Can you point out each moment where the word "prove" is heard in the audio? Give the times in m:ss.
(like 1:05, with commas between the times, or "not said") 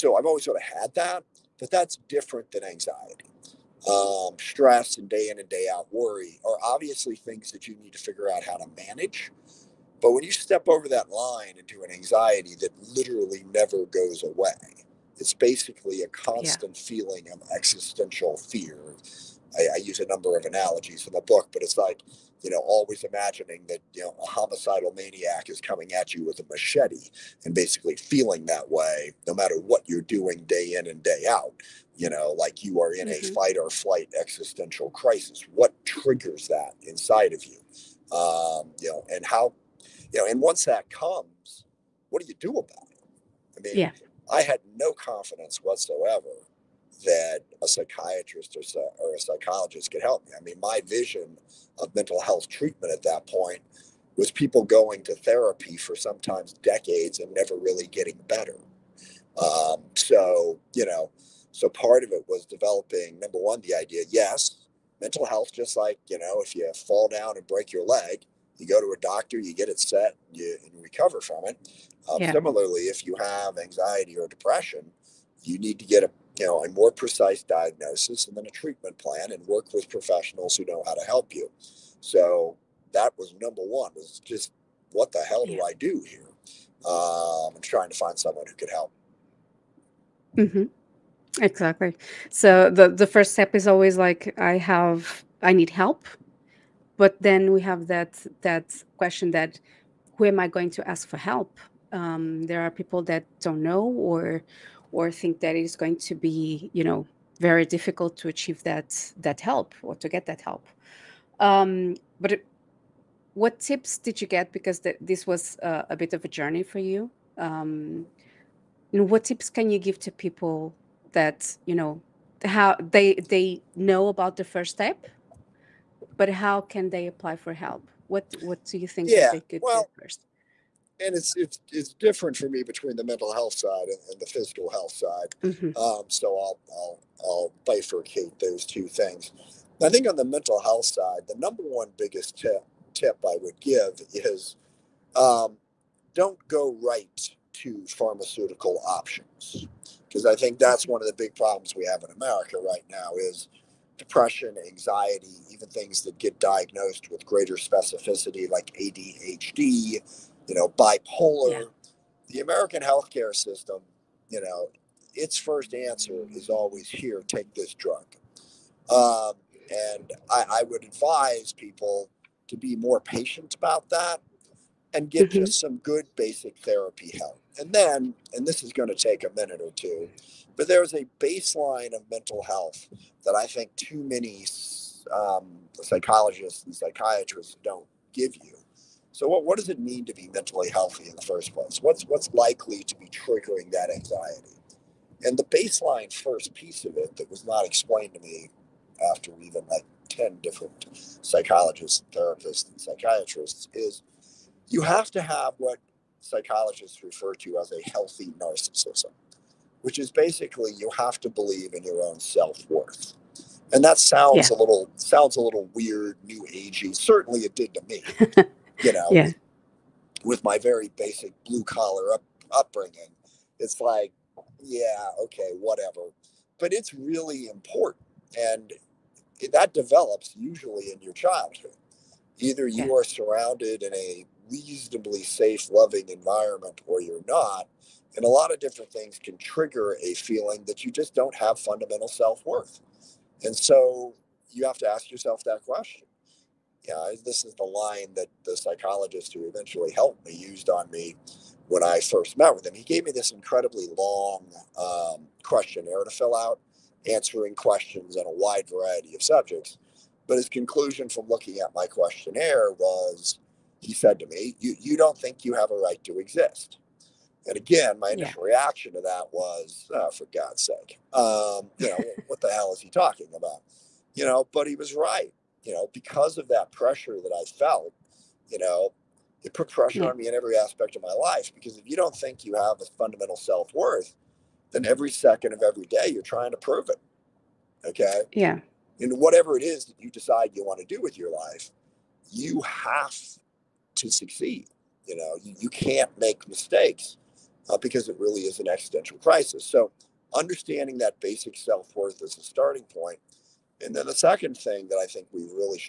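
4:46.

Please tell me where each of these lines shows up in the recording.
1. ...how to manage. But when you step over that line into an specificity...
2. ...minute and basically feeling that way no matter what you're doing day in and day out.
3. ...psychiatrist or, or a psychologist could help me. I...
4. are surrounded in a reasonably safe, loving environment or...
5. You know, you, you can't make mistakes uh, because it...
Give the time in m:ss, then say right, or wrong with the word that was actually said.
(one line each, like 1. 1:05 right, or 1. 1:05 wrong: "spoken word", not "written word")
1. 0:08 wrong: "anxiety", not "specificity"
2. 0:26 wrong: "machete", not "minute"
3. 0:47 right
4. 3:52 right
5. 4:55 right.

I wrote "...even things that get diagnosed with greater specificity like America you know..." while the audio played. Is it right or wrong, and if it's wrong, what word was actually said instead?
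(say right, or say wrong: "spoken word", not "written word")
wrong: "ADHD", not "America".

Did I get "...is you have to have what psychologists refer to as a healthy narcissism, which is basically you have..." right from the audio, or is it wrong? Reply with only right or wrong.
right.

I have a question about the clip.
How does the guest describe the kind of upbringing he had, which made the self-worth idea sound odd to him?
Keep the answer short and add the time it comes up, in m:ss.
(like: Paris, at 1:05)
blue collar, at 3:41.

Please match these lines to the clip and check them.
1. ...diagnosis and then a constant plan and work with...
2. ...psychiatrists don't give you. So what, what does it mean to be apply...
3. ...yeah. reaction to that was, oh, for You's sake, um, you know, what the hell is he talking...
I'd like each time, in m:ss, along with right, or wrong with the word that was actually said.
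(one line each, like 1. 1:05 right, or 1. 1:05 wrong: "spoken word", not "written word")
1. 1:17 wrong: "treatment", not "constant"
2. 3:06 wrong: "mentally", not "apply"
3. 4:28 wrong: "God", not "You".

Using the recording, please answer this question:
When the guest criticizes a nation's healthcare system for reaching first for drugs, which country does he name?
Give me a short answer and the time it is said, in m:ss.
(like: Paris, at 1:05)
America, at 2:32.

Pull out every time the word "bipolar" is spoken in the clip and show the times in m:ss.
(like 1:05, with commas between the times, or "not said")
2:40.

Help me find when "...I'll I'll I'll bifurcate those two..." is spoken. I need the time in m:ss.
2:16.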